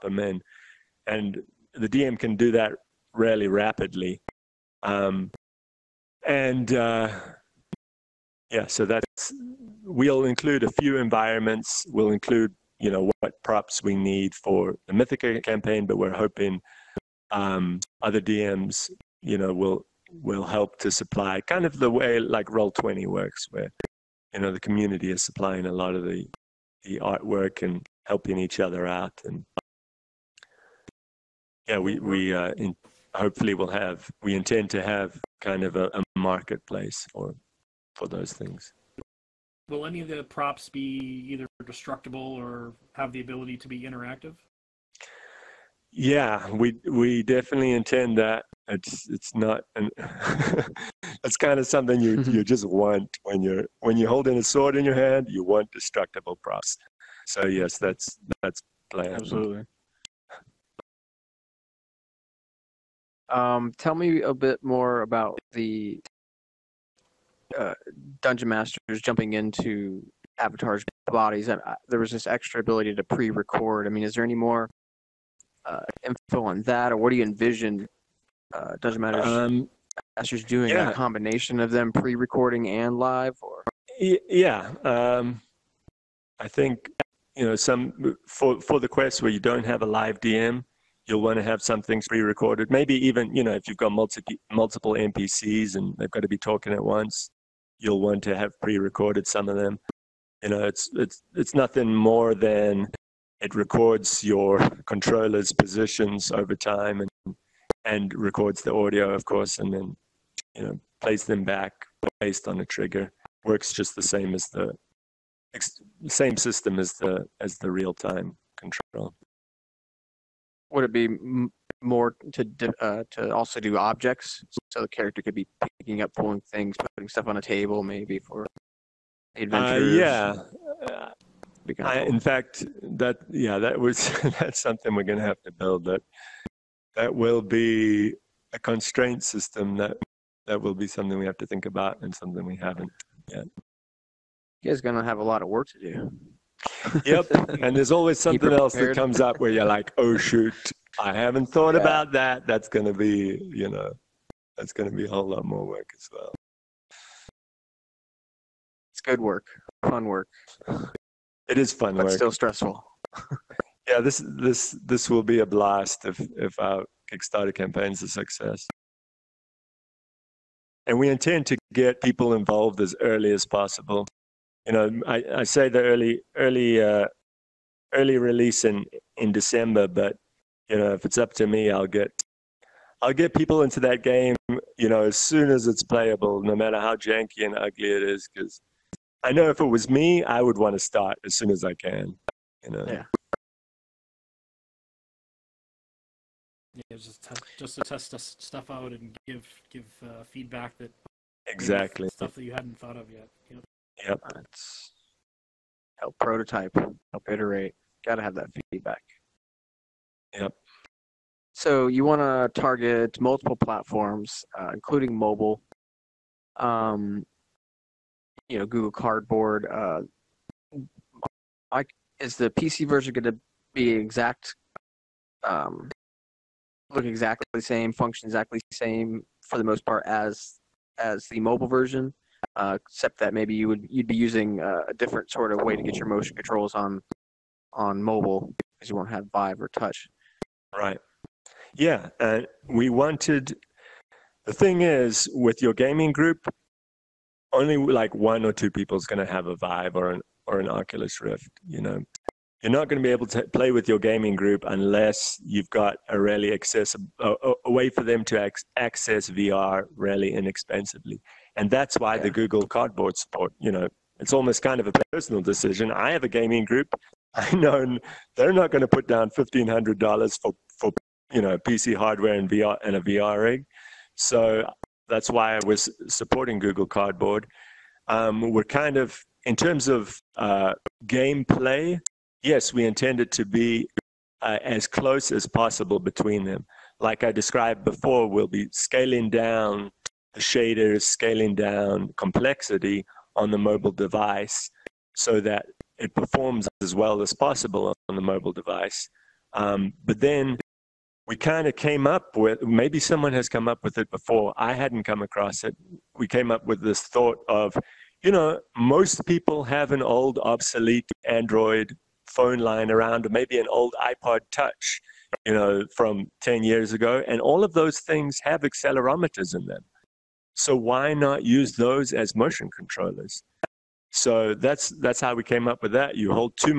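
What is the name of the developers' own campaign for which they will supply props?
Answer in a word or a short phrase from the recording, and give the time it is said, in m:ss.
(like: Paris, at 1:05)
Mythica, at 0:14.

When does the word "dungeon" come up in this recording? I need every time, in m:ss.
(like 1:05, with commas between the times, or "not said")
1:08, 1:18.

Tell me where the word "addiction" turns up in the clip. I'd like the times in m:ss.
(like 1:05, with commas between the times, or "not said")
not said.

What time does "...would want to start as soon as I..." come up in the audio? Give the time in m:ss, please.
3:10.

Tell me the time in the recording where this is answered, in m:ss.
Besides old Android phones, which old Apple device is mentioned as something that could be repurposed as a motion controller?
5:14.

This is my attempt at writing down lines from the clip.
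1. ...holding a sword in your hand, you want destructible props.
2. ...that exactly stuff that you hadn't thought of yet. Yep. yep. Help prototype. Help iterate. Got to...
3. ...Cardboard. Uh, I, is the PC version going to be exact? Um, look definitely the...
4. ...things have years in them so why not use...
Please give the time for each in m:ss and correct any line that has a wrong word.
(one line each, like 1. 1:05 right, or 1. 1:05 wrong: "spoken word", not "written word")
1. 0:54 right
2. 3:20 right
3. 3:38 wrong: "exactly", not "definitely"
4. 5:18 wrong: "accelerometers", not "years".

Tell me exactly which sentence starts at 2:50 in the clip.
And we intend to get people involved as early as possible.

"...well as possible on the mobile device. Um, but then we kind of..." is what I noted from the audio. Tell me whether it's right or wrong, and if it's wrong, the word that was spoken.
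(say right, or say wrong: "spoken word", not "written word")
right.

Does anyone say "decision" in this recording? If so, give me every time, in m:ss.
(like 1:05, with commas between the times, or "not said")
4:25.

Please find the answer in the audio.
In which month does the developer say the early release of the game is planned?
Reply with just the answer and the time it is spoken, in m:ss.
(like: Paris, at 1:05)
December, at 2:59.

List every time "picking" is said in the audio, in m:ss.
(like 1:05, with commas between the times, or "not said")
2:05.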